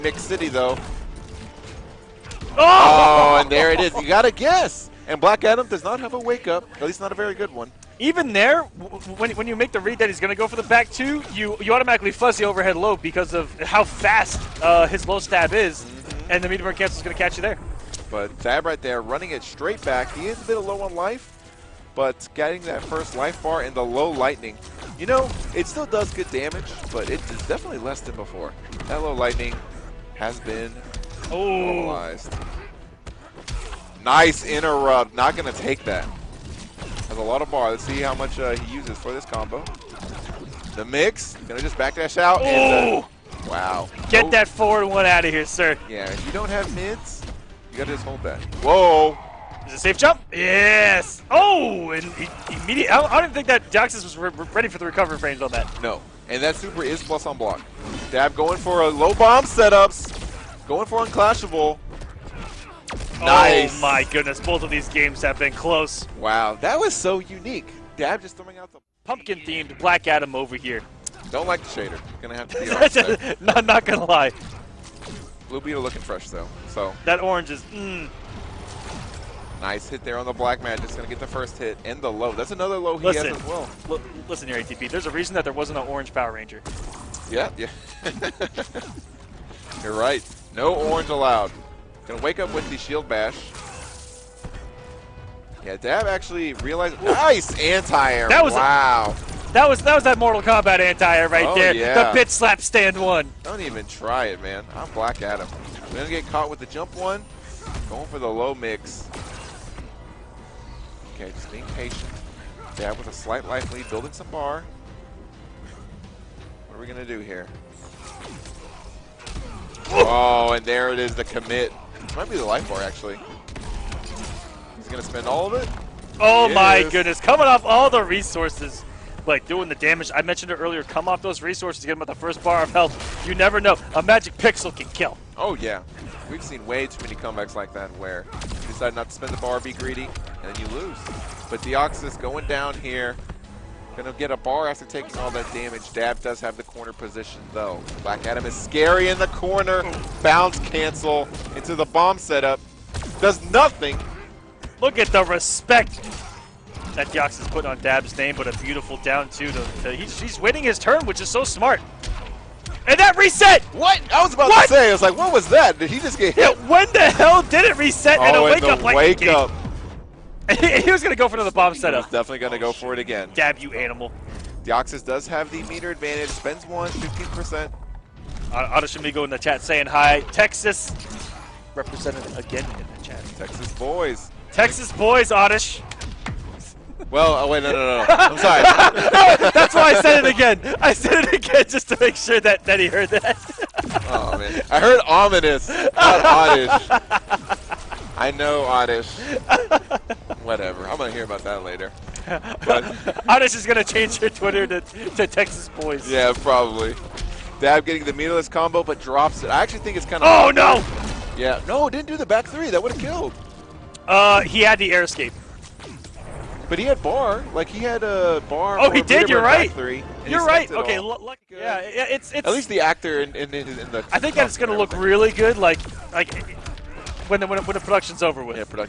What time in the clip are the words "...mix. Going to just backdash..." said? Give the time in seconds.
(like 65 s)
40 s.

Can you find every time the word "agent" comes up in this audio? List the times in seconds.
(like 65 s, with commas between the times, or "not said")
not said.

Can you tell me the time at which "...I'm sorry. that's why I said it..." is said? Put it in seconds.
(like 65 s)
188 s.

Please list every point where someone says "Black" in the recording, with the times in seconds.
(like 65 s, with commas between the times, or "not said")
5 s, 69 s, 80 s, 104 s, 148 s.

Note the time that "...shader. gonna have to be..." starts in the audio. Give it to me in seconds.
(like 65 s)
71 s.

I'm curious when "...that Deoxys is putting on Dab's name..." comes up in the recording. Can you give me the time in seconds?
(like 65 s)
156 s.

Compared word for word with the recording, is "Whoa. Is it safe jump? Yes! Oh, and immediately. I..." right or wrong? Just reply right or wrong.
right.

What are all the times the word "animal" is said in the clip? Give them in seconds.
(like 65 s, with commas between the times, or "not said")
173 s.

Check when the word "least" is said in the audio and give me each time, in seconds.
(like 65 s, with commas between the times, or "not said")
6 s, 222 s.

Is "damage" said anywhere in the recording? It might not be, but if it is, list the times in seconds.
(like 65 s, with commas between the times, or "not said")
26 s, 129 s, 145 s.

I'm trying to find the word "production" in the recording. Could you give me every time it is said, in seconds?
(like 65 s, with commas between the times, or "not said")
227 s.